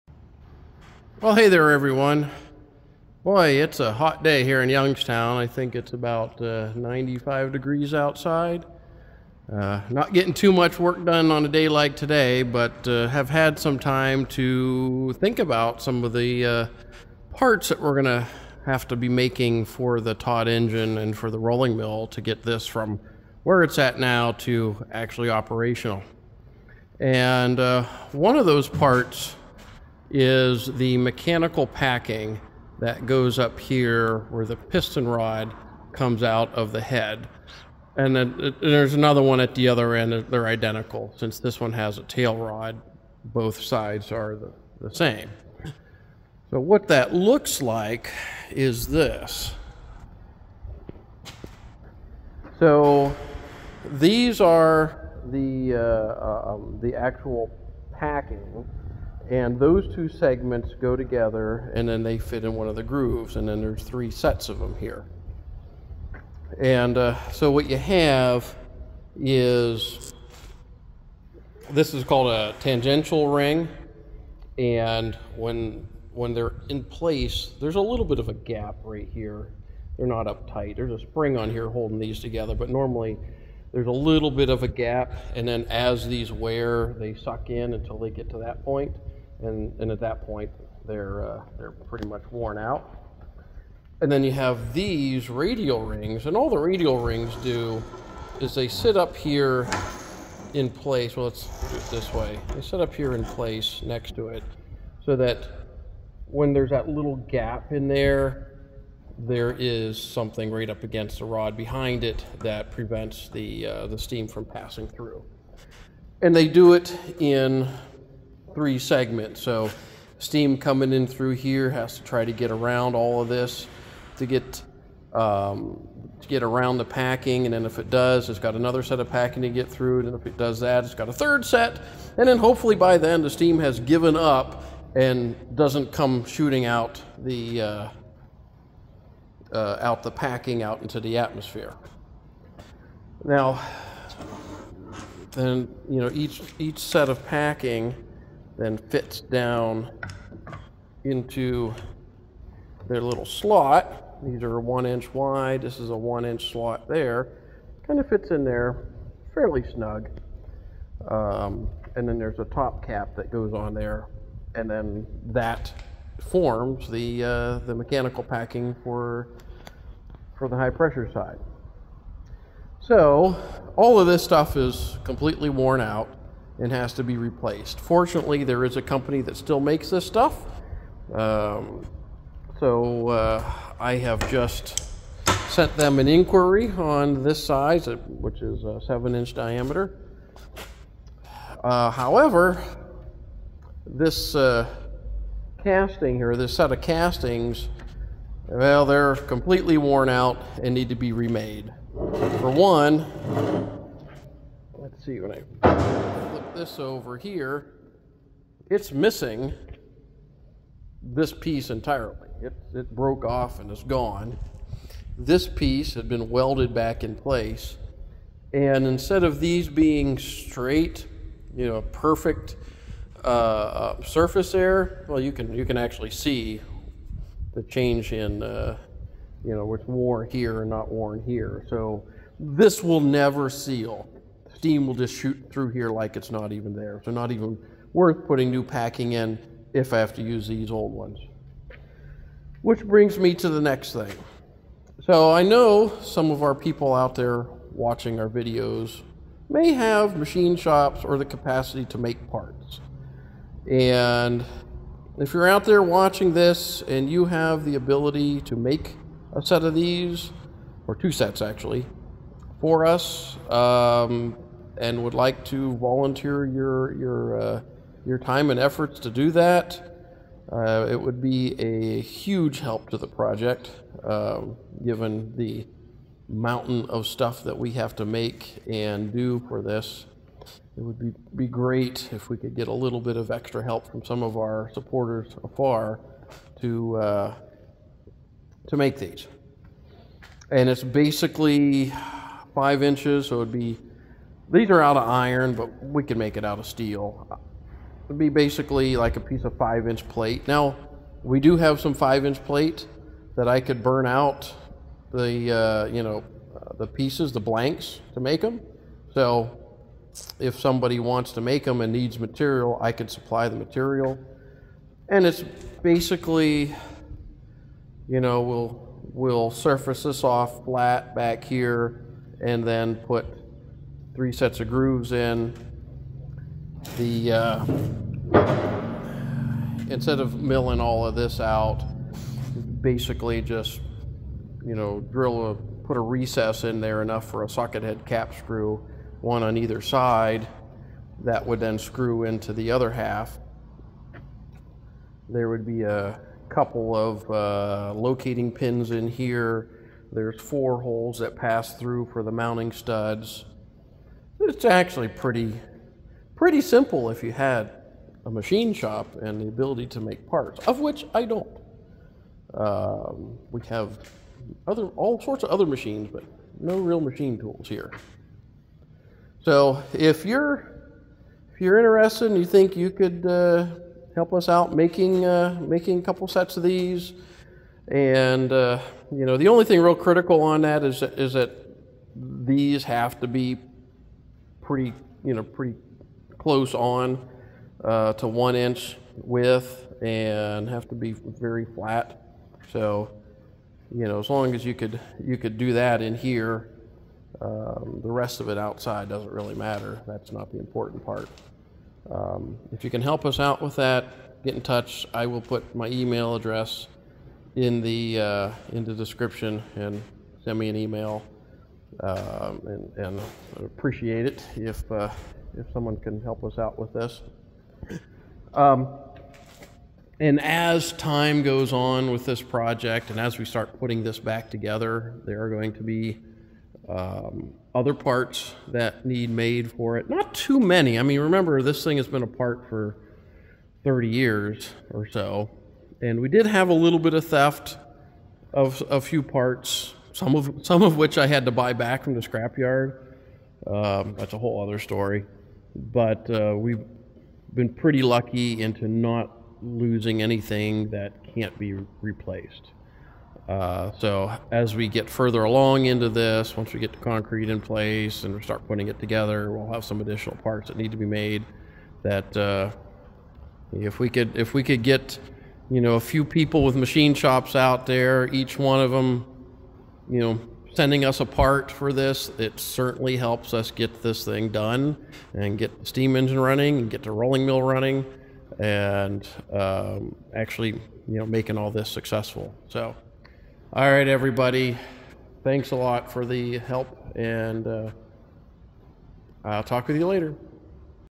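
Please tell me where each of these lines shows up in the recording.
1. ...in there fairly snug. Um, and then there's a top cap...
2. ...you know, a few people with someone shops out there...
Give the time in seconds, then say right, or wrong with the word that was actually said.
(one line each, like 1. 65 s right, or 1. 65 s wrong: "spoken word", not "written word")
1. 158 s right
2. 465 s wrong: "machine", not "someone".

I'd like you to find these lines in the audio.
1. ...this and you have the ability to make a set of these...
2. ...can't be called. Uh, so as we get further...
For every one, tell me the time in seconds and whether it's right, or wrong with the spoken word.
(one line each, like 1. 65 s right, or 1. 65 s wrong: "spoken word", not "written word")
1. 256 s right
2. 451 s wrong: "replaced", not "called".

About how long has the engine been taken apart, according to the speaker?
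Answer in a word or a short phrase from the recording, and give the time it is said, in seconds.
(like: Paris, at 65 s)
30 years, at 433 s.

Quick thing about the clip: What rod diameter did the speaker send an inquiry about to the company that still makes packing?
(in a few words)
7 inches.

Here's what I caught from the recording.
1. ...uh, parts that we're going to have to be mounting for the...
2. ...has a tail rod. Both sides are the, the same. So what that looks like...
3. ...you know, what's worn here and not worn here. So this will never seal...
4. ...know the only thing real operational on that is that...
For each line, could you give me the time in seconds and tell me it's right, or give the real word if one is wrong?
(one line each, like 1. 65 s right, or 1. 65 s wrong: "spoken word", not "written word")
1. 16 s wrong: "making", not "mounting"
2. 41 s right
3. 229 s right
4. 379 s wrong: "critical", not "operational".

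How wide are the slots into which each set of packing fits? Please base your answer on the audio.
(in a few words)
1 inch.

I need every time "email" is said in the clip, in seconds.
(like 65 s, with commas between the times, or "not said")
405 s, 410 s.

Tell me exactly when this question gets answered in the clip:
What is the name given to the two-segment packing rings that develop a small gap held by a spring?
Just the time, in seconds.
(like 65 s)
72 s.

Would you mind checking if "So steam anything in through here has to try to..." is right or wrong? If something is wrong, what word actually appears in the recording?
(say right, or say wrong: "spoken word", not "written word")
wrong: "coming", not "anything".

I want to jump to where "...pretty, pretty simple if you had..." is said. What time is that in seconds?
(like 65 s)
355 s.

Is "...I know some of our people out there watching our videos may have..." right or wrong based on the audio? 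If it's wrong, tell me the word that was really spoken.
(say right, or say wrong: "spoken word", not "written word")
right.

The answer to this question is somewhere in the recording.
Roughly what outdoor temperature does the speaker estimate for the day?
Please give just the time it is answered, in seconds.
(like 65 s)
6 s.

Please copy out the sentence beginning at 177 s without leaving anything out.
Fortunately, there is a company that still makes this stuff.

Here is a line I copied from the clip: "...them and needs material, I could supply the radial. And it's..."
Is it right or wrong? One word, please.
wrong.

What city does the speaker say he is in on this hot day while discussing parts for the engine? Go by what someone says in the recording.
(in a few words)
Youngstown.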